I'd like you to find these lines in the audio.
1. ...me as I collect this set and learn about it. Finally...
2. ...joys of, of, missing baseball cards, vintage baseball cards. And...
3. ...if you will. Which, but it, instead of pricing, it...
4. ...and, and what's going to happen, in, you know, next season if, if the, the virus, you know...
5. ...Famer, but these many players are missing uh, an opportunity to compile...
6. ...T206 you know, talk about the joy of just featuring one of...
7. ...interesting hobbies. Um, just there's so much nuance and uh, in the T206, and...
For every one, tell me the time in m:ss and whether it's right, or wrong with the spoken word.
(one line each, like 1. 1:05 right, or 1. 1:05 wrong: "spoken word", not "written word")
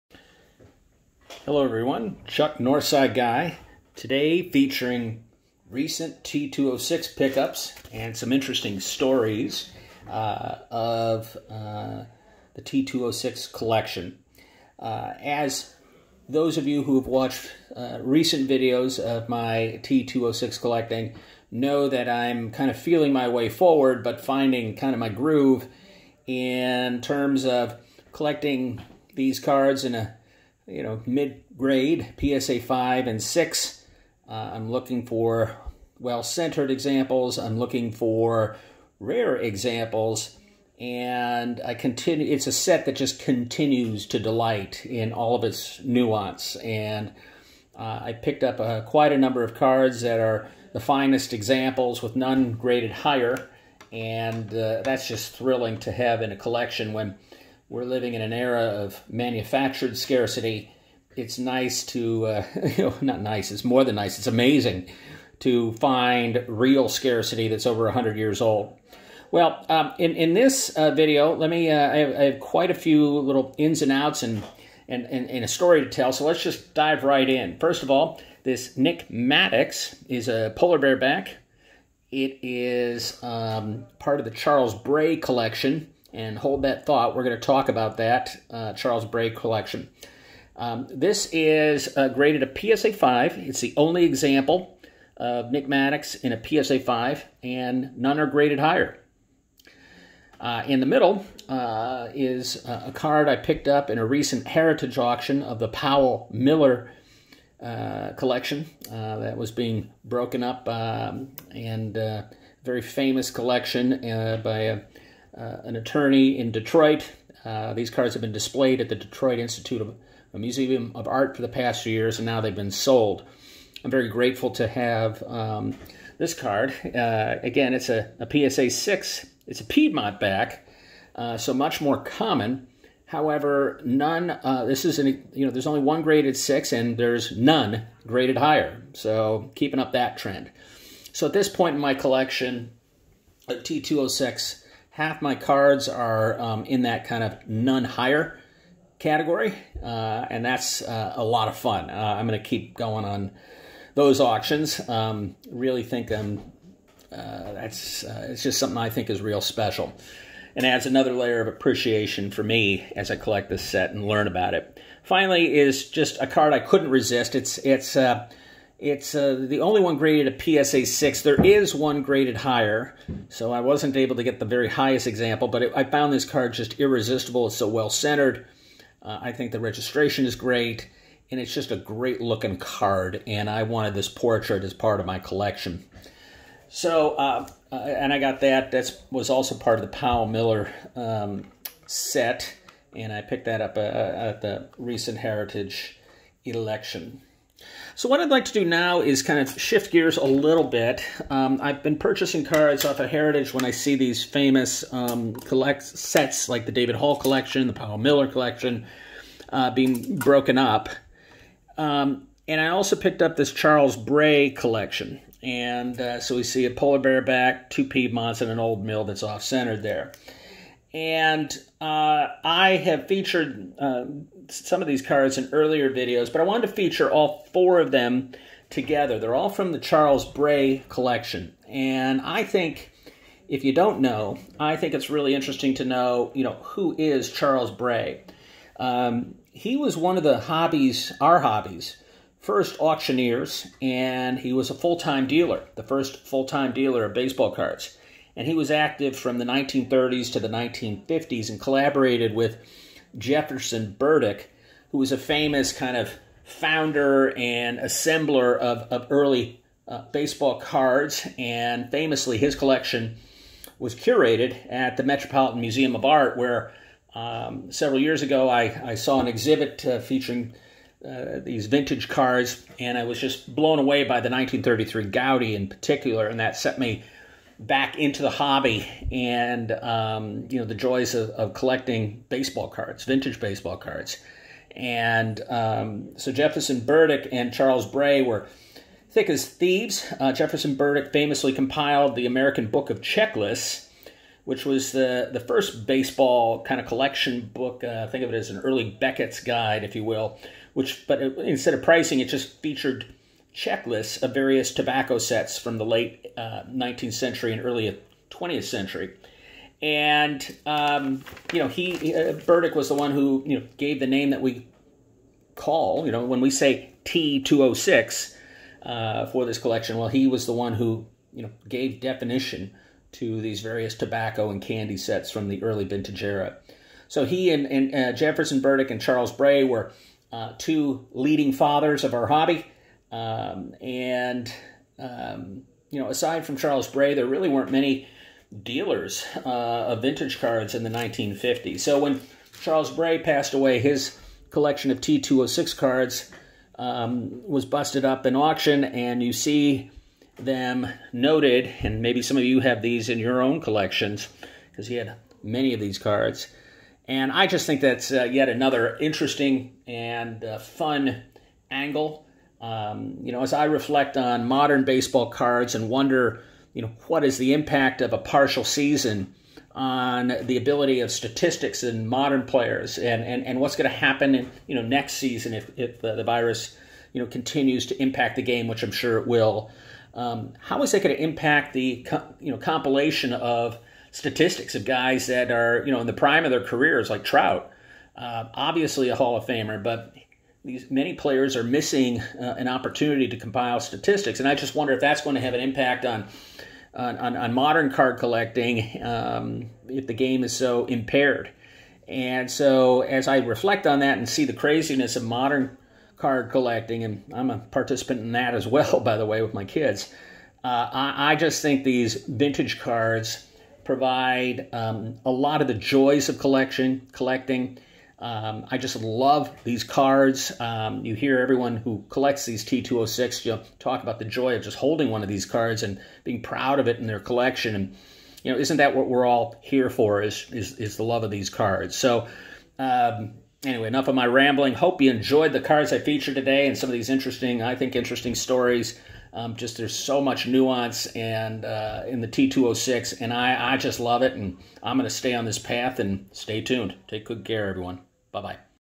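1. 2:42 right
2. 4:40 wrong: "collecting", not "missing"
3. 4:59 right
4. 6:13 right
5. 6:29 right
6. 7:02 wrong: "holding", not "featuring"
7. 7:17 wrong: "stories", not "hobbies".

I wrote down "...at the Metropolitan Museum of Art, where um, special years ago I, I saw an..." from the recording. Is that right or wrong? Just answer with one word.
wrong.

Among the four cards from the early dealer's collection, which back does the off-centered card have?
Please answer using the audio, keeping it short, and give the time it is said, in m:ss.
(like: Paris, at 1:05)
Old Mill, at 3:38.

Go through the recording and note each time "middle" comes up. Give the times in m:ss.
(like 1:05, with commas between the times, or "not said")
1:40.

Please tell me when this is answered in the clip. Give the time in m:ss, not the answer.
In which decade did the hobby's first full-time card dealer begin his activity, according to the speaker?
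4:09.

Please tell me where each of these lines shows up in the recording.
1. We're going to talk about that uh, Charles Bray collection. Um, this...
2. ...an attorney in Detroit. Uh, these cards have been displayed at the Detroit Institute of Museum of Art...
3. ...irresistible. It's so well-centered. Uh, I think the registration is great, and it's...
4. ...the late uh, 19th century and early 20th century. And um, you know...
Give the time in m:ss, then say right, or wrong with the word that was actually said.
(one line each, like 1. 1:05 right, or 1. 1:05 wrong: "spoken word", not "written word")
1. 1:27 right
2. 1:55 right
3. 2:56 right
4. 5:05 right.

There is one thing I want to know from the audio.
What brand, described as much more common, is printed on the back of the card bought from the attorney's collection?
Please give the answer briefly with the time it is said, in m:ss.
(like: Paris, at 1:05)
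Piedmont, at 2:09.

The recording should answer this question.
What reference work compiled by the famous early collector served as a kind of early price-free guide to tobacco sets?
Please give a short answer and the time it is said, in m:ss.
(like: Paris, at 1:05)
American Book of Checklists, at 4:52.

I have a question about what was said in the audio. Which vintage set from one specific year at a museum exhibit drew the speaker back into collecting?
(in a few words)
1933 Goudey.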